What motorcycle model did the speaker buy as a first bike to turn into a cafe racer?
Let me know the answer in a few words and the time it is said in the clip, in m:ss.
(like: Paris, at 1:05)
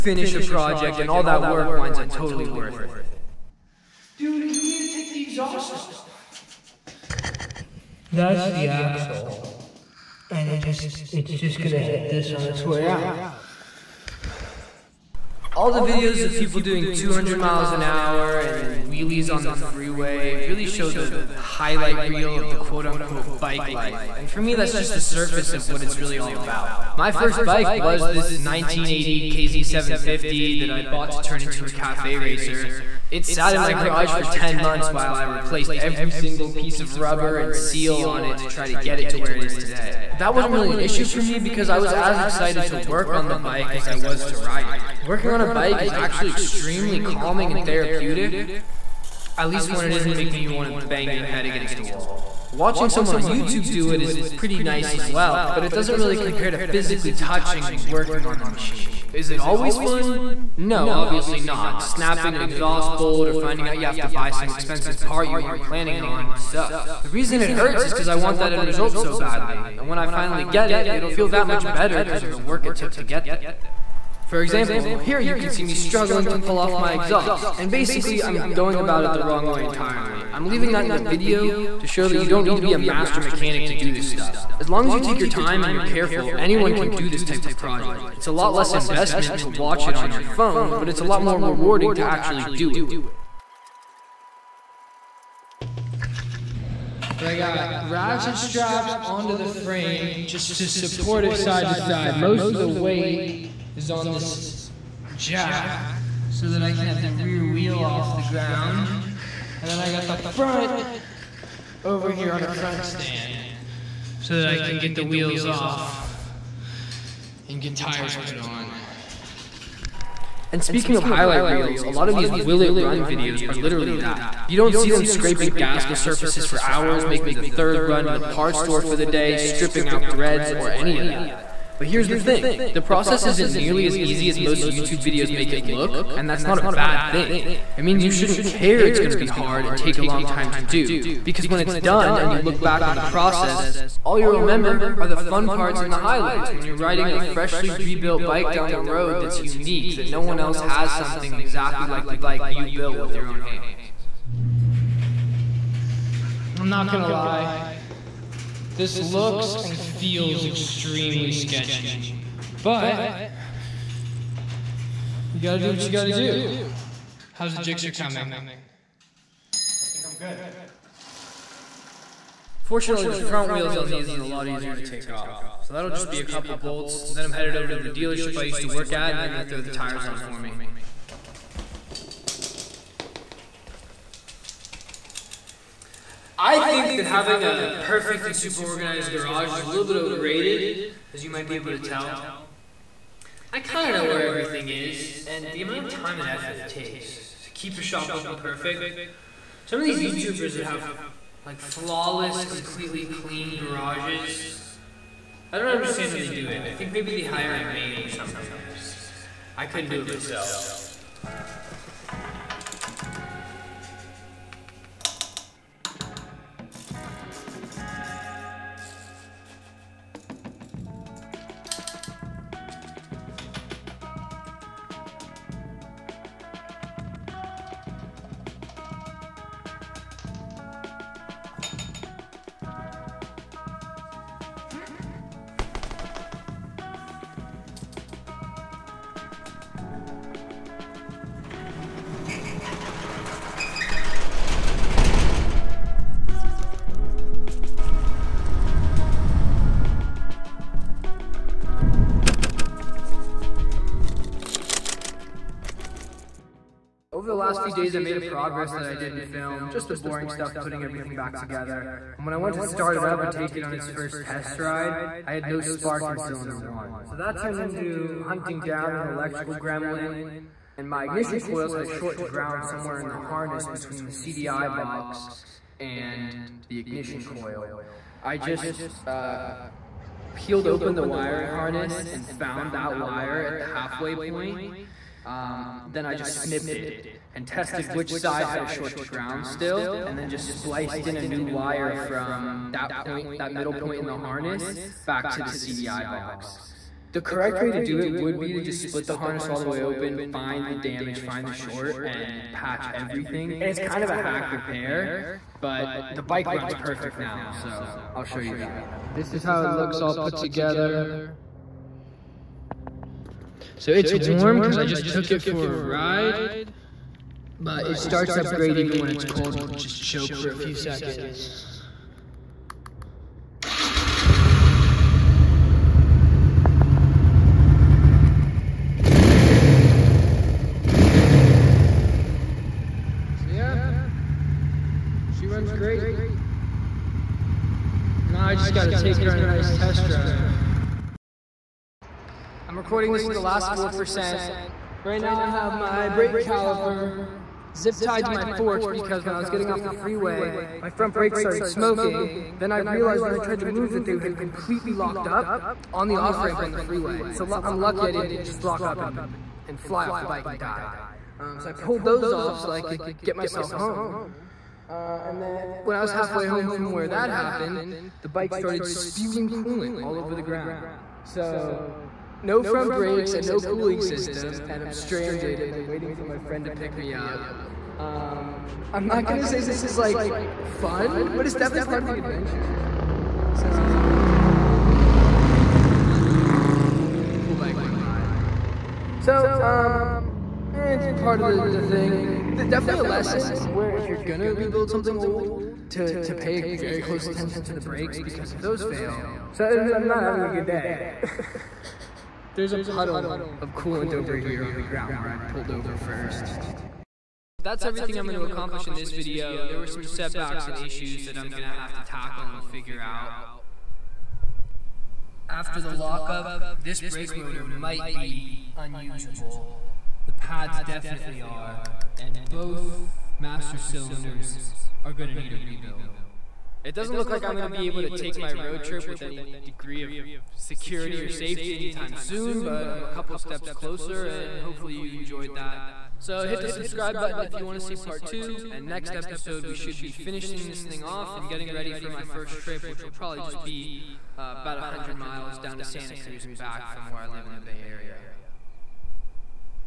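KZ750, at 0:29.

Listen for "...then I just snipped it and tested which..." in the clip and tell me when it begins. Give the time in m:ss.
4:45.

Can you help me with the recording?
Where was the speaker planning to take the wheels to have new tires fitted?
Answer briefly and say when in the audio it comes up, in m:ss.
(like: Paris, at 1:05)
the dealership, at 2:57.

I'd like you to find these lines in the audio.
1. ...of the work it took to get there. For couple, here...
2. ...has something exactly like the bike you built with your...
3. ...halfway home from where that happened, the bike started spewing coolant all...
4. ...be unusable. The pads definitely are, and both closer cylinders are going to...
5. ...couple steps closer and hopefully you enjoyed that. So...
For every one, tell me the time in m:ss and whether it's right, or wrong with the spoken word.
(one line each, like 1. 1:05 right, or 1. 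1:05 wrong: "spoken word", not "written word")
1. 1:12 wrong: "example", not "couple"
2. 2:30 right
3. 6:06 right
4. 6:58 wrong: "master", not "closer"
5. 7:13 right.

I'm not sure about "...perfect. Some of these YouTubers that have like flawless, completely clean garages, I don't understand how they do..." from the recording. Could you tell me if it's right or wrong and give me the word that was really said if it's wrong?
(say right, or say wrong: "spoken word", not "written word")
right.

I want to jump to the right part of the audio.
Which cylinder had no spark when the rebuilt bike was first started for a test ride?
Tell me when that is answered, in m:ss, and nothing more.
4:26.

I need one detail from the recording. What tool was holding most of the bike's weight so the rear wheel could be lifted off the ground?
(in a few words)
jack.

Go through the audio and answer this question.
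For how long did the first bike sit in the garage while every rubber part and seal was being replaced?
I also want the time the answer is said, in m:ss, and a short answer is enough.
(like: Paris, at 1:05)
10 months, at 0:34.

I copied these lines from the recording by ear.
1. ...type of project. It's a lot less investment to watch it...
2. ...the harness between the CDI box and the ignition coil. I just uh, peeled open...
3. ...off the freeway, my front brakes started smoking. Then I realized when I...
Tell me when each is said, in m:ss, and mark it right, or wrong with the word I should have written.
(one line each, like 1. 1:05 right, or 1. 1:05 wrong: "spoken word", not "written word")
1. 1:27 right
2. 4:33 right
3. 5:49 right.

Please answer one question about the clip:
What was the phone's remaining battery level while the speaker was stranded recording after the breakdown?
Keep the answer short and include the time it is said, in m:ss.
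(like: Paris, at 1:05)
4%, at 5:43.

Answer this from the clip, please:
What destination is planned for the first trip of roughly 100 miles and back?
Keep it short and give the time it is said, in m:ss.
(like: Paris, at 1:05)
Santa Cruz, at 7:25.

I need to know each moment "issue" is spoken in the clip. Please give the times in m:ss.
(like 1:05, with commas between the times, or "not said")
0:40, 6:50.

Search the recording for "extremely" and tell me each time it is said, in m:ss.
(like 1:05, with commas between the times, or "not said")
0:46, 2:40.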